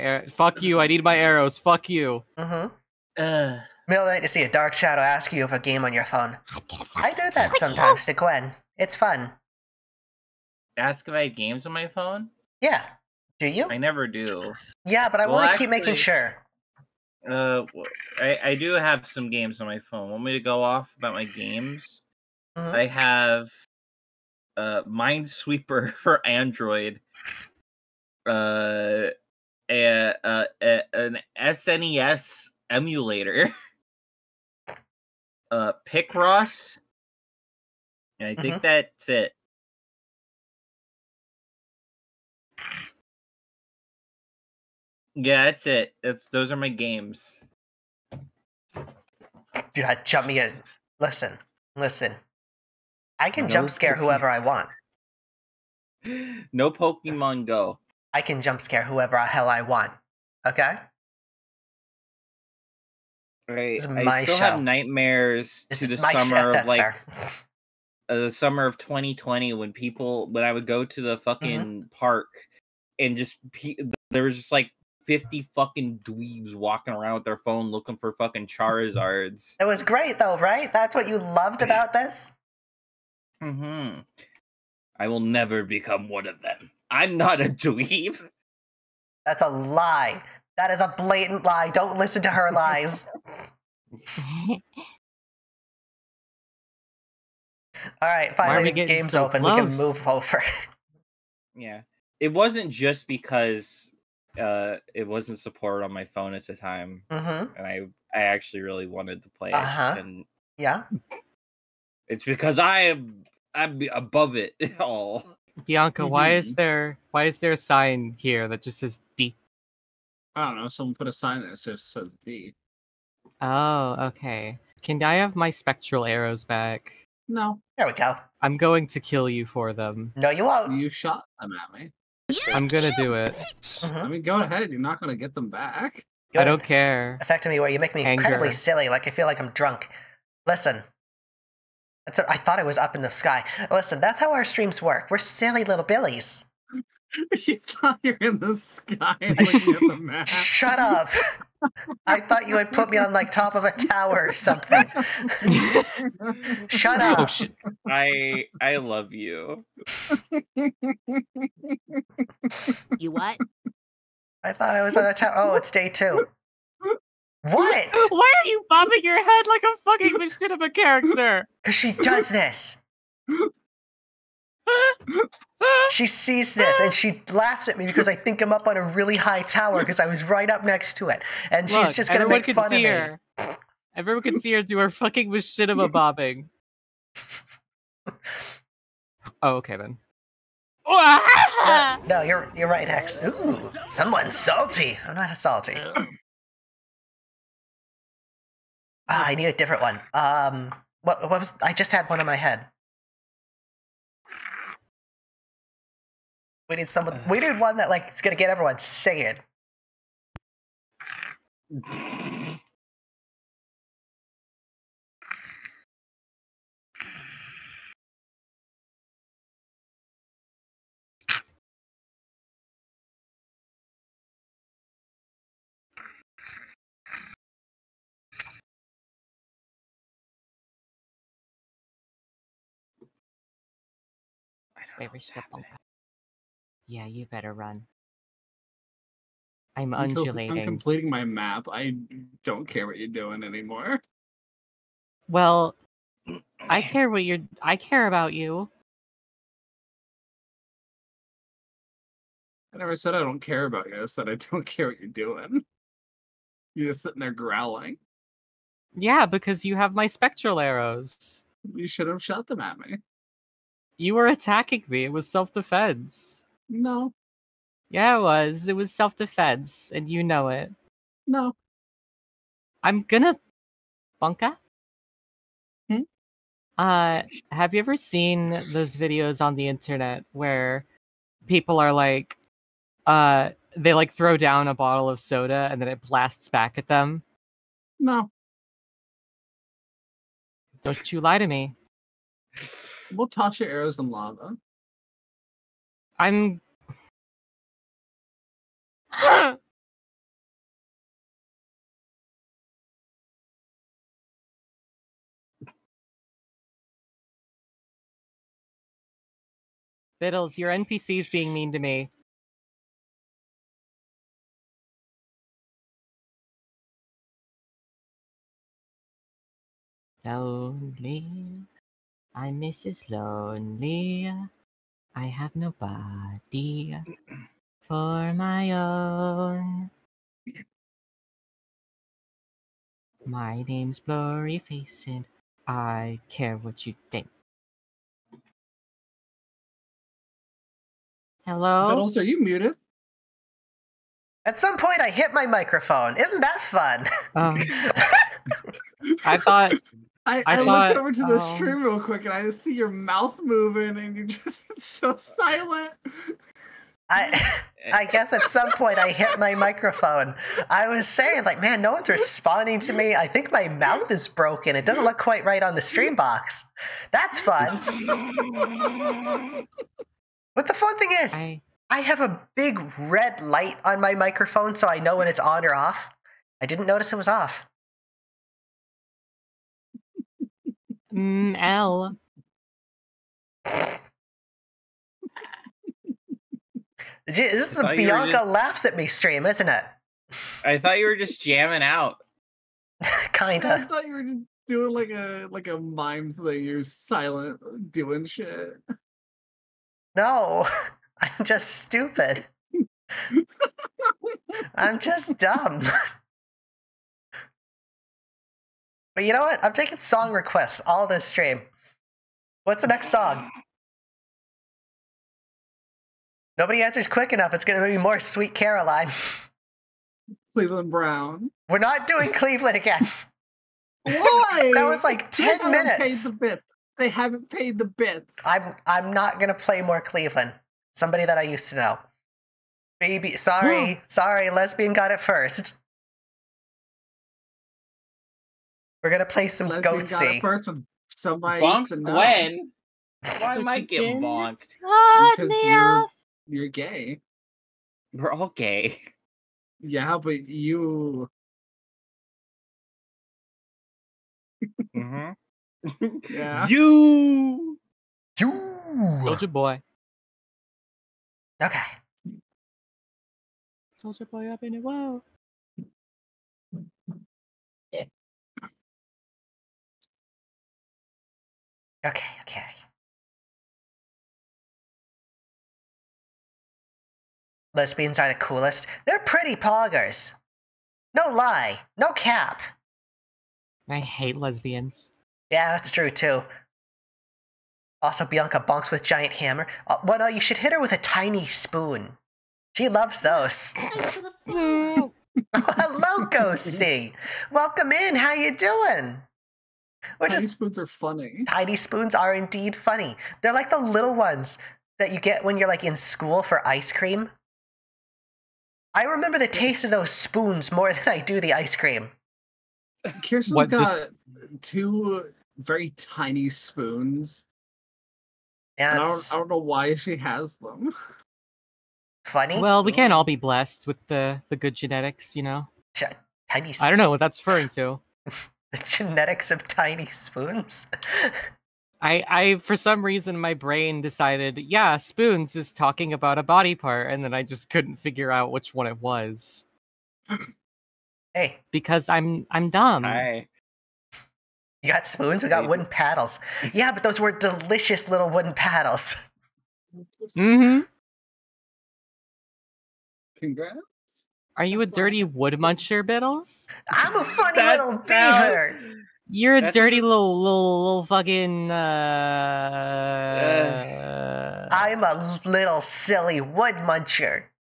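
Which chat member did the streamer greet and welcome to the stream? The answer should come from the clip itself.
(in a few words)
Ghosty.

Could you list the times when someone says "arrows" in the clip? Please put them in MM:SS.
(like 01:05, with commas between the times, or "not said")
00:01, 02:06, 04:20, 04:53.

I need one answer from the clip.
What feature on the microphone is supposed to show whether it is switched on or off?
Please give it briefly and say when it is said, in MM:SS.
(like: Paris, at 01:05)
Big red light, at 06:12.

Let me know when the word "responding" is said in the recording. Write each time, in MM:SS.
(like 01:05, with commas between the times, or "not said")
06:02.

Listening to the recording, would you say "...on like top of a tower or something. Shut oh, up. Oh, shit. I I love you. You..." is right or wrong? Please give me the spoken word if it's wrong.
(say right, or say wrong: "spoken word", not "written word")
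right.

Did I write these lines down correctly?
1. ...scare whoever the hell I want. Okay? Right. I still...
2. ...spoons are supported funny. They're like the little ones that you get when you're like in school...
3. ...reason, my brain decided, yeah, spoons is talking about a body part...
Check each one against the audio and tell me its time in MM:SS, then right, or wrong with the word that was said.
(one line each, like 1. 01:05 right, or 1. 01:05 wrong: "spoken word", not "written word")
1. 00:58 right
2. 08:21 wrong: "indeed", not "supported"
3. 08:53 right.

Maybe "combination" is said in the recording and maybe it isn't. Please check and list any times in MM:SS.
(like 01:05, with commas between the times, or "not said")
not said.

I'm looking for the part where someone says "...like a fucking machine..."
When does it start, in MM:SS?
02:49.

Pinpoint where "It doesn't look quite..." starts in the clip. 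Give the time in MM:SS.
06:04.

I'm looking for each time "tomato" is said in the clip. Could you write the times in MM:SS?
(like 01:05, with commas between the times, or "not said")
not said.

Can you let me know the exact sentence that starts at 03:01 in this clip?
And Look, she's just going to make fun see of her.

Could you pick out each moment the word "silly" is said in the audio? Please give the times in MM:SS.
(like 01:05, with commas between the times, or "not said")
02:18, 02:25, 09:25.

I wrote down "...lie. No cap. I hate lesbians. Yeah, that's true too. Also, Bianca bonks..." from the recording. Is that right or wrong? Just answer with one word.
right.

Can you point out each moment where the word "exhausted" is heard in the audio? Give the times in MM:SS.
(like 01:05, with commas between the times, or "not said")
not said.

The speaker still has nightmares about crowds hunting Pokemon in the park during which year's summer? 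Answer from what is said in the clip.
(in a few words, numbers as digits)
2020.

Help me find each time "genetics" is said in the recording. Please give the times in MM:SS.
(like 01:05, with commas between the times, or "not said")
08:44, 08:48.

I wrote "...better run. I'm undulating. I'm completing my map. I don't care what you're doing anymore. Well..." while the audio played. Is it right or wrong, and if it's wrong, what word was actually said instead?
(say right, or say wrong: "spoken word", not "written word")
right.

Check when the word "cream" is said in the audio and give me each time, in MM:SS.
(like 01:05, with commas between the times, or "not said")
08:26, 08:31.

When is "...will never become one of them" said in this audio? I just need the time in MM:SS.
01:25.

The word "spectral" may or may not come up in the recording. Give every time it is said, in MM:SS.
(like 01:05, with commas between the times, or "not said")
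02:05, 04:20.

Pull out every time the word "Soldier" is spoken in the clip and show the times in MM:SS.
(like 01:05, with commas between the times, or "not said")
07:39, 07:43.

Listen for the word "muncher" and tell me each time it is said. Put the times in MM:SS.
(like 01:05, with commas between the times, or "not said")
09:15, 09:26.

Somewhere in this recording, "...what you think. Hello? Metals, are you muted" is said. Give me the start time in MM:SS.
05:36.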